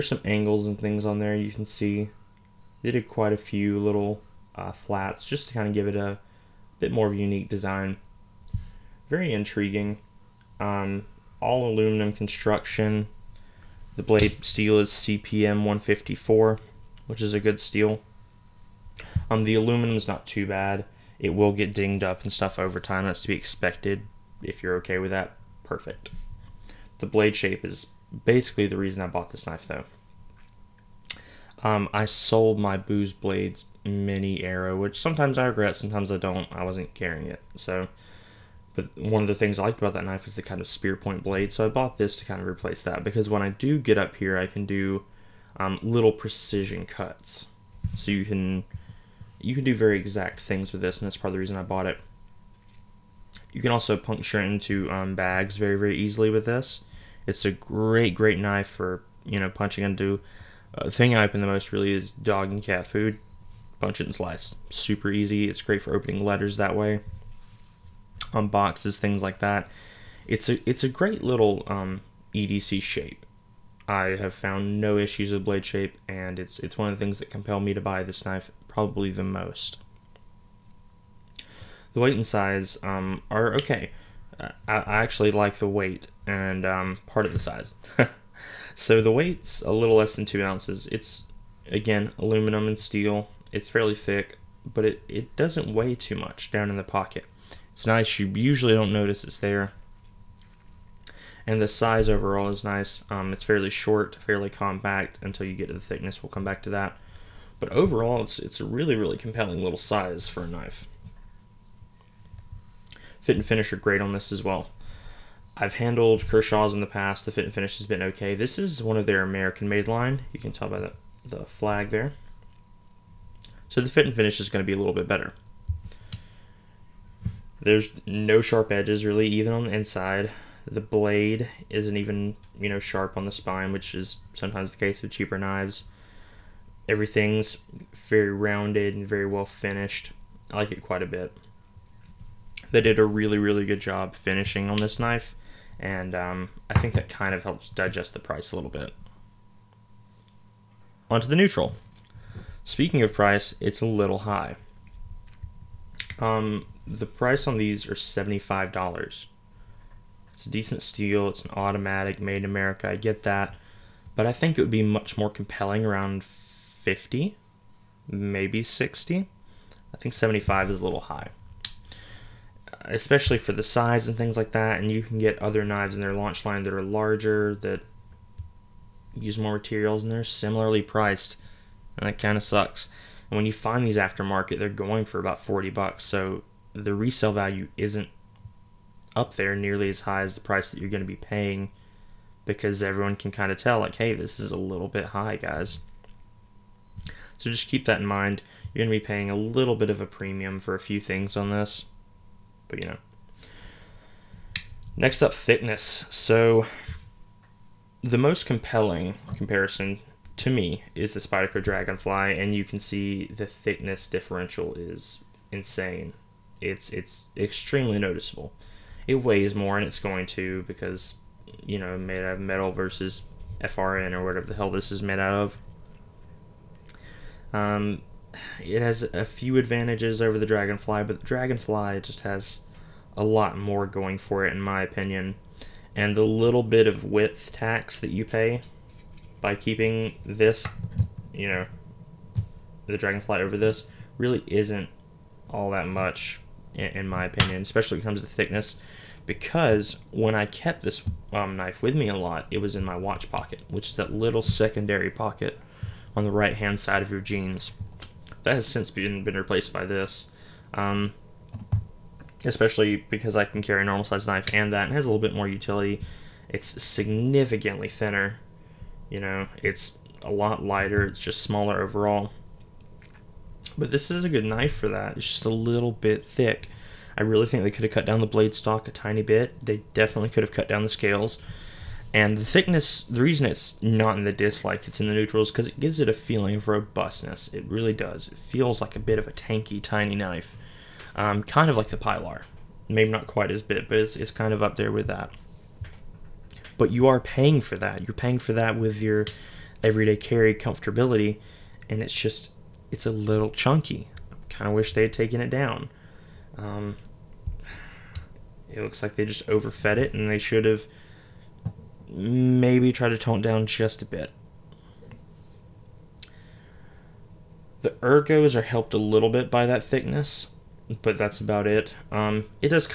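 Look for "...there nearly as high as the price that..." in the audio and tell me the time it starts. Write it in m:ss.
3:09.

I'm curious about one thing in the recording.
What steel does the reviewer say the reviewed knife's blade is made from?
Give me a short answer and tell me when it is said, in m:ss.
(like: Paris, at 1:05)
CPM 154, at 0:14.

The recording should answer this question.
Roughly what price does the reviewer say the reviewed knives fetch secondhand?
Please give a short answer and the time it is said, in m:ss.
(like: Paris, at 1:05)
$40, at 3:05.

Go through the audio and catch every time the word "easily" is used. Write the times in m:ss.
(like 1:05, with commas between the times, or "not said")
0:55.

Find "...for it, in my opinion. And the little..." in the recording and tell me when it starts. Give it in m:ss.
3:54.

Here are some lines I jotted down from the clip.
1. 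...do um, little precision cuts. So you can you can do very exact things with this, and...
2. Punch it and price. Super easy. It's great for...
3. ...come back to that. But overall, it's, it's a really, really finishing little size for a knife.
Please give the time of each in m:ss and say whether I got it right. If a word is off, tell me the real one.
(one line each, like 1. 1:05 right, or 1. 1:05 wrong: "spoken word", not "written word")
1. 0:44 right
2. 1:03 wrong: "slice", not "price"
3. 1:46 wrong: "compelling", not "finishing".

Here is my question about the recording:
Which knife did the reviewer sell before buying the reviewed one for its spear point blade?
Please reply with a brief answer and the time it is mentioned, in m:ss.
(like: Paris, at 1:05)
Boos Blades mini arrow, at 0:32.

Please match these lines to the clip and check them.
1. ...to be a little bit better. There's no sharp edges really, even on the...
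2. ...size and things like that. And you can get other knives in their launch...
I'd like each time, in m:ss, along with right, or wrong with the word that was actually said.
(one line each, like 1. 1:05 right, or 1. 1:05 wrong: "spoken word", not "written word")
1. 2:04 right
2. 2:53 right.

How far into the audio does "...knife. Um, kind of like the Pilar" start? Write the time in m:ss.
4:50.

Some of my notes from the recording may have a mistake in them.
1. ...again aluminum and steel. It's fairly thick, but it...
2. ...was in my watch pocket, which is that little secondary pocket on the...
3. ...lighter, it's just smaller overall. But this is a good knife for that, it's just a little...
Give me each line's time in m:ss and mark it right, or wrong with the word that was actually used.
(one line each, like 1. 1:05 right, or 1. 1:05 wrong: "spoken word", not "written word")
1. 1:31 right
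2. 4:12 right
3. 4:30 right.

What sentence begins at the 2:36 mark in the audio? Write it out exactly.
Um, the price on these are $75.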